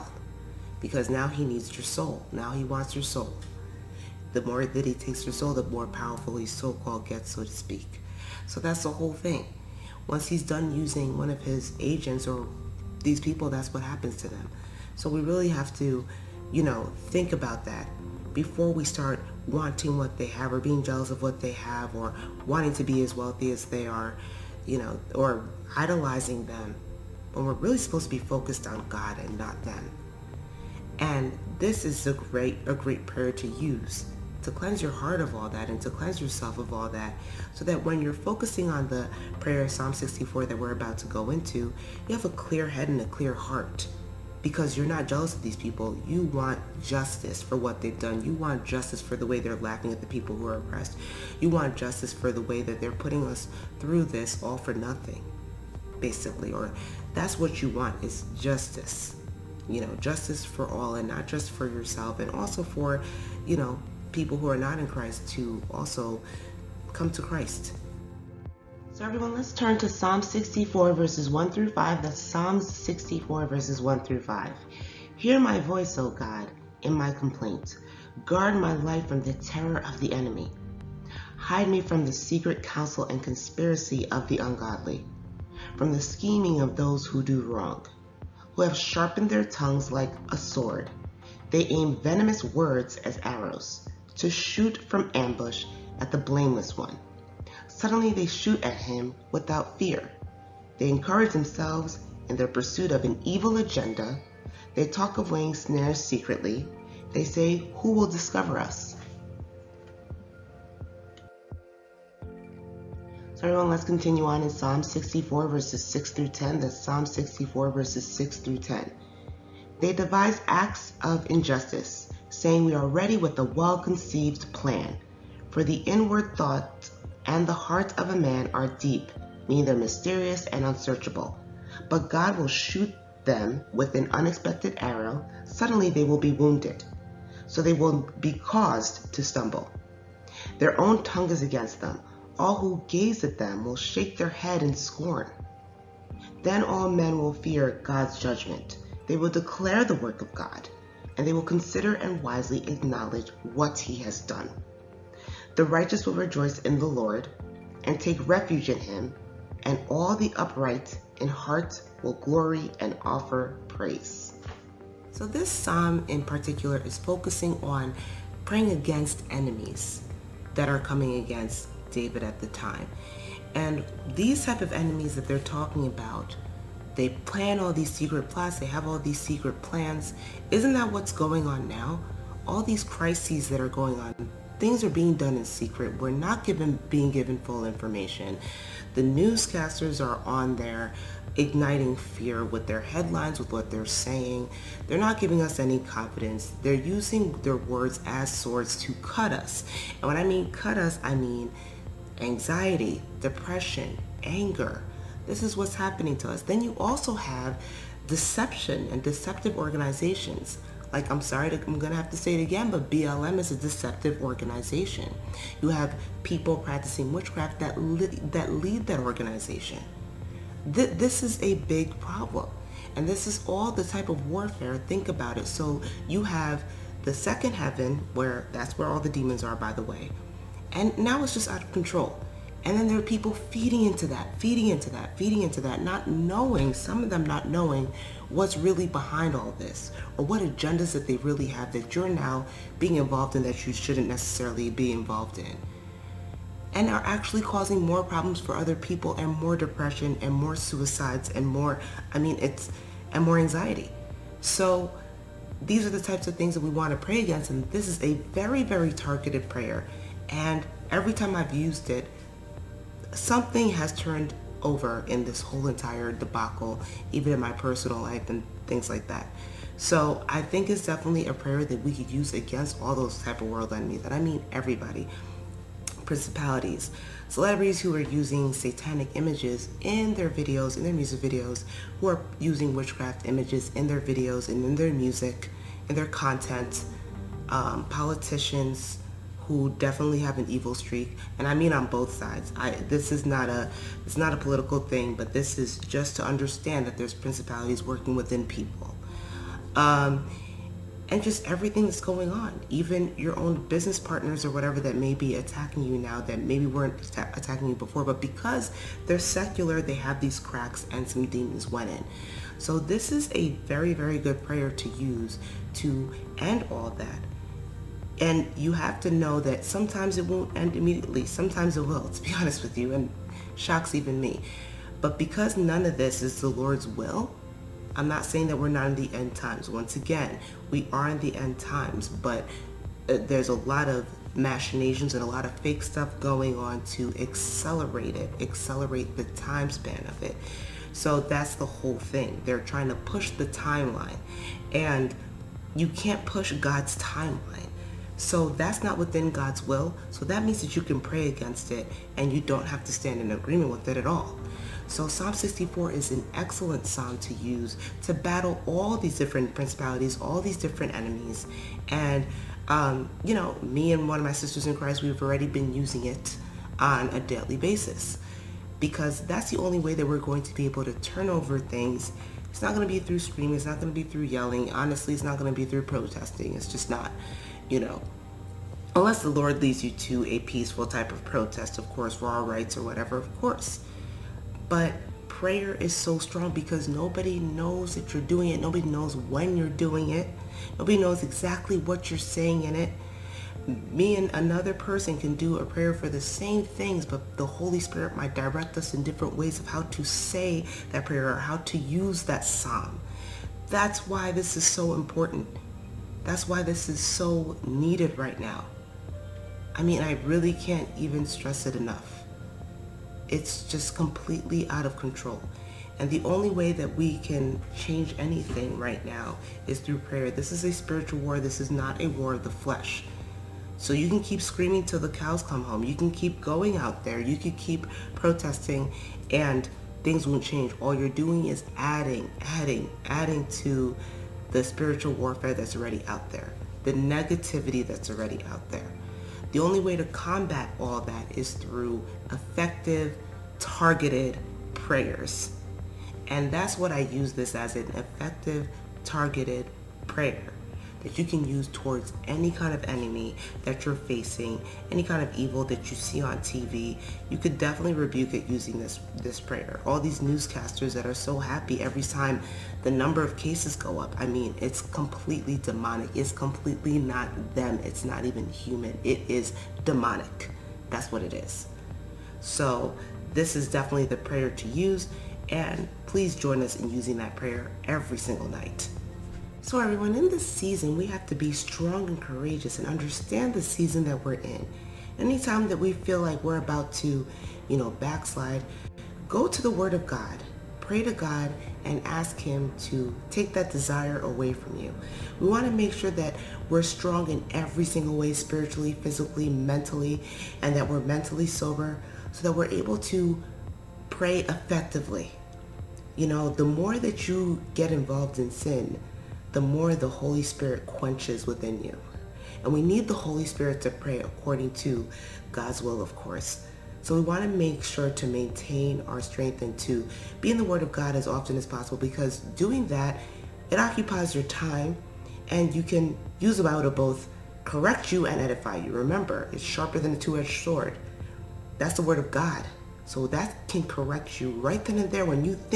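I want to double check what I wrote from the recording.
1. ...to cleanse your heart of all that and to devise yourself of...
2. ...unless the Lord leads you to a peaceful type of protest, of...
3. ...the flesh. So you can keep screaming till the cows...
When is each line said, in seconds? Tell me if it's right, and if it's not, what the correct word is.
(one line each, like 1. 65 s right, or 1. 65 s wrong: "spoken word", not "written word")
1. 34 s wrong: "cleanse", not "devise"
2. 378 s right
3. 422 s right.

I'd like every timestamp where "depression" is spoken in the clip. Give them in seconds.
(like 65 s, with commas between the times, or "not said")
203 s, 249 s.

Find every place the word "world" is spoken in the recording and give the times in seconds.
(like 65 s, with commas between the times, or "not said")
273 s.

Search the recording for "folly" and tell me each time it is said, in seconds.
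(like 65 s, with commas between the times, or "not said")
not said.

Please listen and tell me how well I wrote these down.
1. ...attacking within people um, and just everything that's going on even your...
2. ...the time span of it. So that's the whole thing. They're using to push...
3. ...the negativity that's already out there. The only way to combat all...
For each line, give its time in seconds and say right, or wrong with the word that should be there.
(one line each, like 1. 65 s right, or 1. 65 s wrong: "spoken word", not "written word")
1. 297 s wrong: "working", not "attacking"
2. 339 s wrong: "trying", not "using"
3. 436 s right.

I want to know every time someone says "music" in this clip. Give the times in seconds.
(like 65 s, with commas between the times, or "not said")
280 s, 284 s.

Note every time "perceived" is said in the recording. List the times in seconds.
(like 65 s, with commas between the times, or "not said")
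not said.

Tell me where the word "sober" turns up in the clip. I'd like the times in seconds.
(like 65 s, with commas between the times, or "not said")
501 s.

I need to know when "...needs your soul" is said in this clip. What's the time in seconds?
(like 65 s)
1 s.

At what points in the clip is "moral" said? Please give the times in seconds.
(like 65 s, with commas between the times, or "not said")
not said.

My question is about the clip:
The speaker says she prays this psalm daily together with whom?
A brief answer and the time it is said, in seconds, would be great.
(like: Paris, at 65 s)
one of my sisters in Christ, at 364 s.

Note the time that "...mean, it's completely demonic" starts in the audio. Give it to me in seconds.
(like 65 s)
464 s.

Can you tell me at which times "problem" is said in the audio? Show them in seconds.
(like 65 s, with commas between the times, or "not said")
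221 s, 248 s.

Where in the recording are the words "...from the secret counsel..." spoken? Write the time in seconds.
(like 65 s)
81 s.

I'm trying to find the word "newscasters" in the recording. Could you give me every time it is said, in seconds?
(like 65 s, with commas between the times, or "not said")
189 s, 460 s.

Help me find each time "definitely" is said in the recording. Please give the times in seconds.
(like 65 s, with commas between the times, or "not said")
270 s, 289 s, 457 s, 473 s.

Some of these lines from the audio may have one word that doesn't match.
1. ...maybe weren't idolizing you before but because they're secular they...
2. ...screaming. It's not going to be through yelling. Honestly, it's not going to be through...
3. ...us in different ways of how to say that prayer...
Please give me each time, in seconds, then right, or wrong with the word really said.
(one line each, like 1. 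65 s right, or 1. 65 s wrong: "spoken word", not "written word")
1. 306 s wrong: "attacking", not "idolizing"
2. 373 s right
3. 398 s right.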